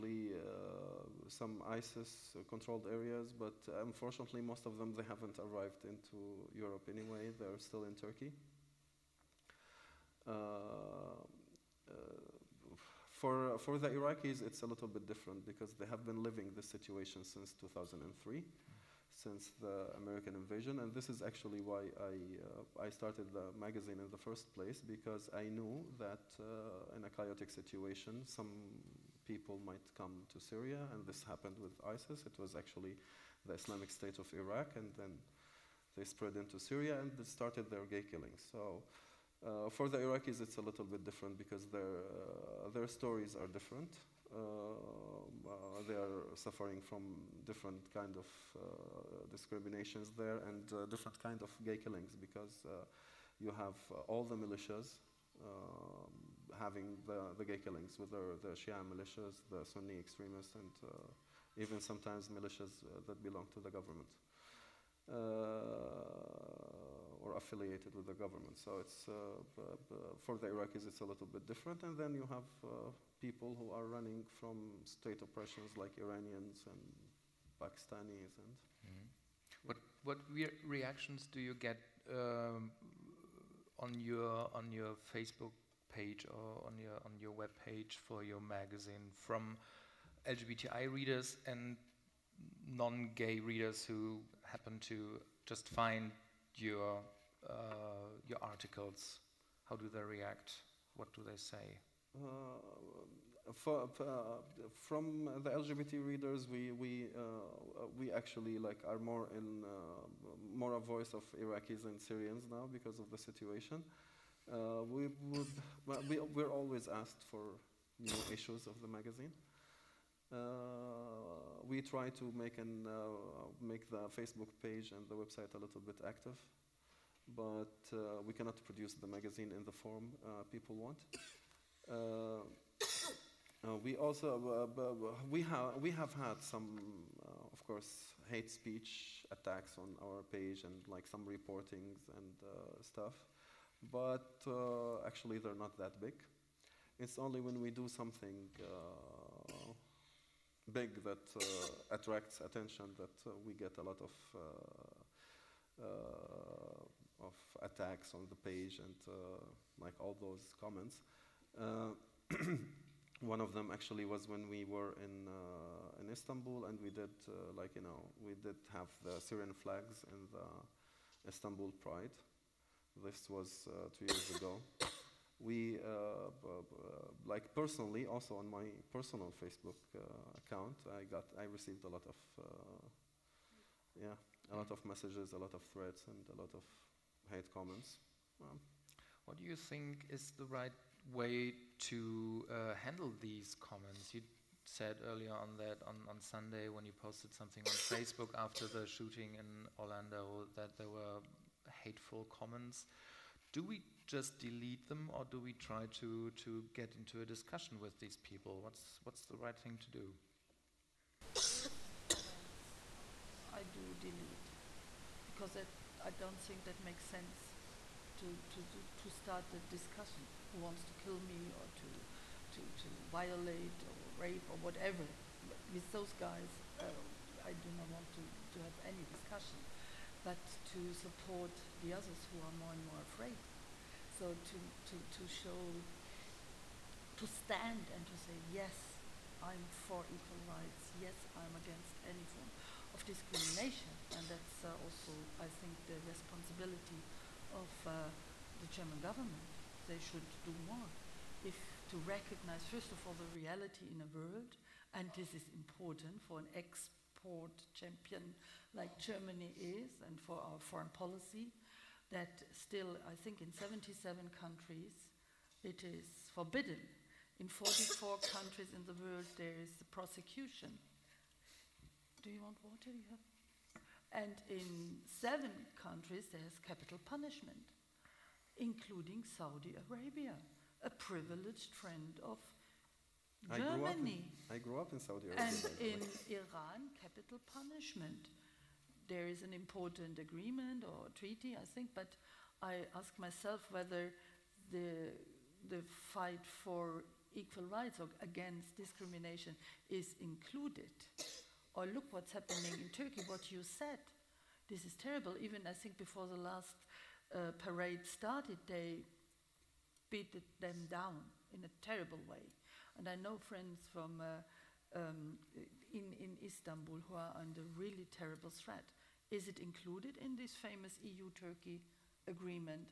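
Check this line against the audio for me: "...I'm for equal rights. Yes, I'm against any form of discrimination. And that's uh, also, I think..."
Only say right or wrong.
right.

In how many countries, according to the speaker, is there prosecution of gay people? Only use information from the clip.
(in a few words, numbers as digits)
44.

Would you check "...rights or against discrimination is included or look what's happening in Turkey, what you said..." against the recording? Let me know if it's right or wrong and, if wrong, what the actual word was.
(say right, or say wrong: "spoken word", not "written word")
right.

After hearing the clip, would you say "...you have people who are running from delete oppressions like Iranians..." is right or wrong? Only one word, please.
wrong.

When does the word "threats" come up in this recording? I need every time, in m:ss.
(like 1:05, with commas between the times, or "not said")
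3:05, 5:18.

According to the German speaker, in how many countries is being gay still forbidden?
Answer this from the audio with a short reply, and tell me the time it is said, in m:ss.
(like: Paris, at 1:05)
77, at 4:23.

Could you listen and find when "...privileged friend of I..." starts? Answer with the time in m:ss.
4:40.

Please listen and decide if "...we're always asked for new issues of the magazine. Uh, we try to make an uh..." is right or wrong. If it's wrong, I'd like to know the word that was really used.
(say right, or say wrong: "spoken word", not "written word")
right.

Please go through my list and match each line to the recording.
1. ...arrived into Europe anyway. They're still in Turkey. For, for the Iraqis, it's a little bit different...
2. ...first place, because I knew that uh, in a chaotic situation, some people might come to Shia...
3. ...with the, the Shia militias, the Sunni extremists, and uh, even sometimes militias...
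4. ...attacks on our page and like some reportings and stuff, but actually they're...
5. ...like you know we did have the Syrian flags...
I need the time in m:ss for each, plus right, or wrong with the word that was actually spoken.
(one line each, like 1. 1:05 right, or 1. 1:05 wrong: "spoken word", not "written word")
1. 0:05 right
2. 0:24 wrong: "Syria", not "Shia"
3. 0:57 right
4. 2:19 right
5. 2:47 right.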